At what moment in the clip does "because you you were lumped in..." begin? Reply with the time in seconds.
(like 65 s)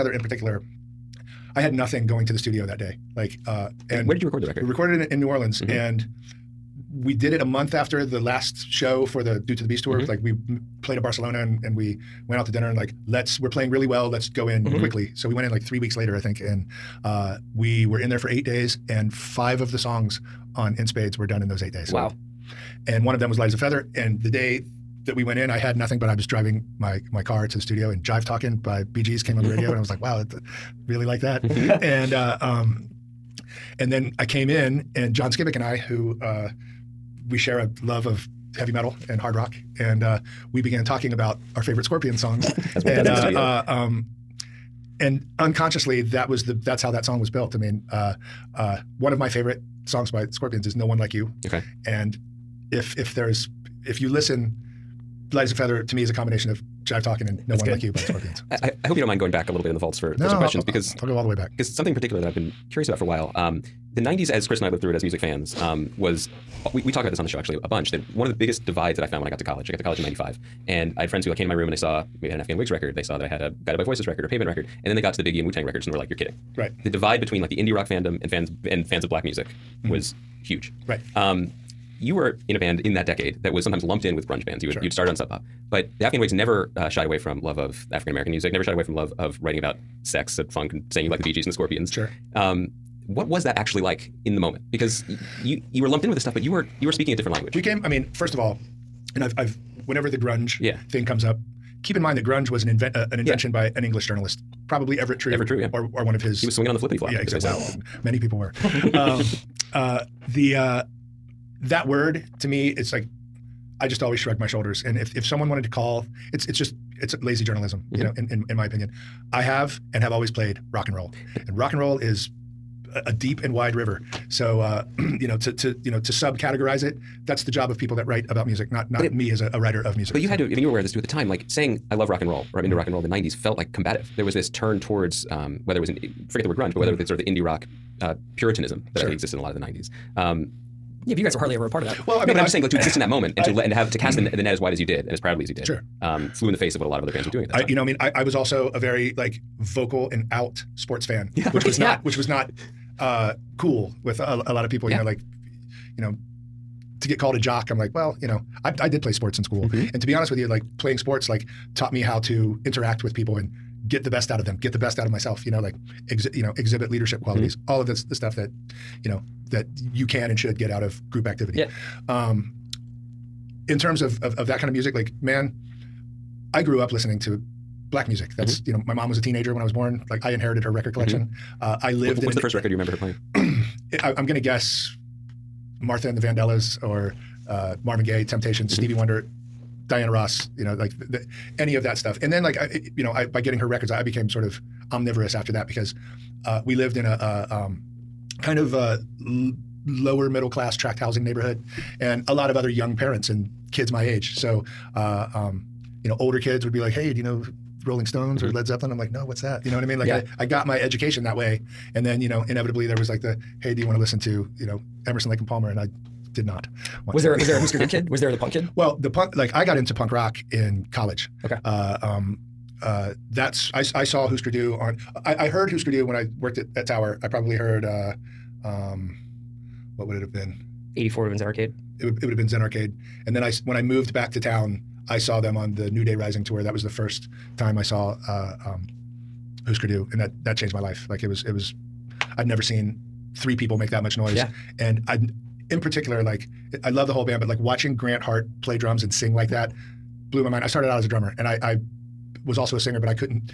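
94 s.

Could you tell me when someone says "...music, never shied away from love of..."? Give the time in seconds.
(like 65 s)
88 s.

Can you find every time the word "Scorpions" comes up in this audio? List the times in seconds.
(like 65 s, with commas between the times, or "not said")
41 s, 50 s, 57 s, 91 s.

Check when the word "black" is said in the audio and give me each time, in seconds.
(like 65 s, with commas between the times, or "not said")
79 s, 177 s.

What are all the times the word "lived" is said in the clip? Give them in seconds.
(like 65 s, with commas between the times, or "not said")
64 s, 181 s, 196 s.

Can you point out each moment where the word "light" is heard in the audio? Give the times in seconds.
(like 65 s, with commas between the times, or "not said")
23 s, 55 s.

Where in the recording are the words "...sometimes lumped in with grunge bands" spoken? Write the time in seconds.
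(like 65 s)
83 s.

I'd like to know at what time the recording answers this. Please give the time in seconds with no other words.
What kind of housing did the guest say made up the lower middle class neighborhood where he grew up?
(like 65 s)
200 s.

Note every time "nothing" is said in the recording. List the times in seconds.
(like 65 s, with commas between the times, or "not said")
1 s, 25 s.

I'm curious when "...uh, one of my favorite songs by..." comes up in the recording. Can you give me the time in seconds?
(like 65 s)
48 s.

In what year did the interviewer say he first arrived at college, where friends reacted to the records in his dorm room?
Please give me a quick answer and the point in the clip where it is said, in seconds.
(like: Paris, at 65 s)
1995, at 70 s.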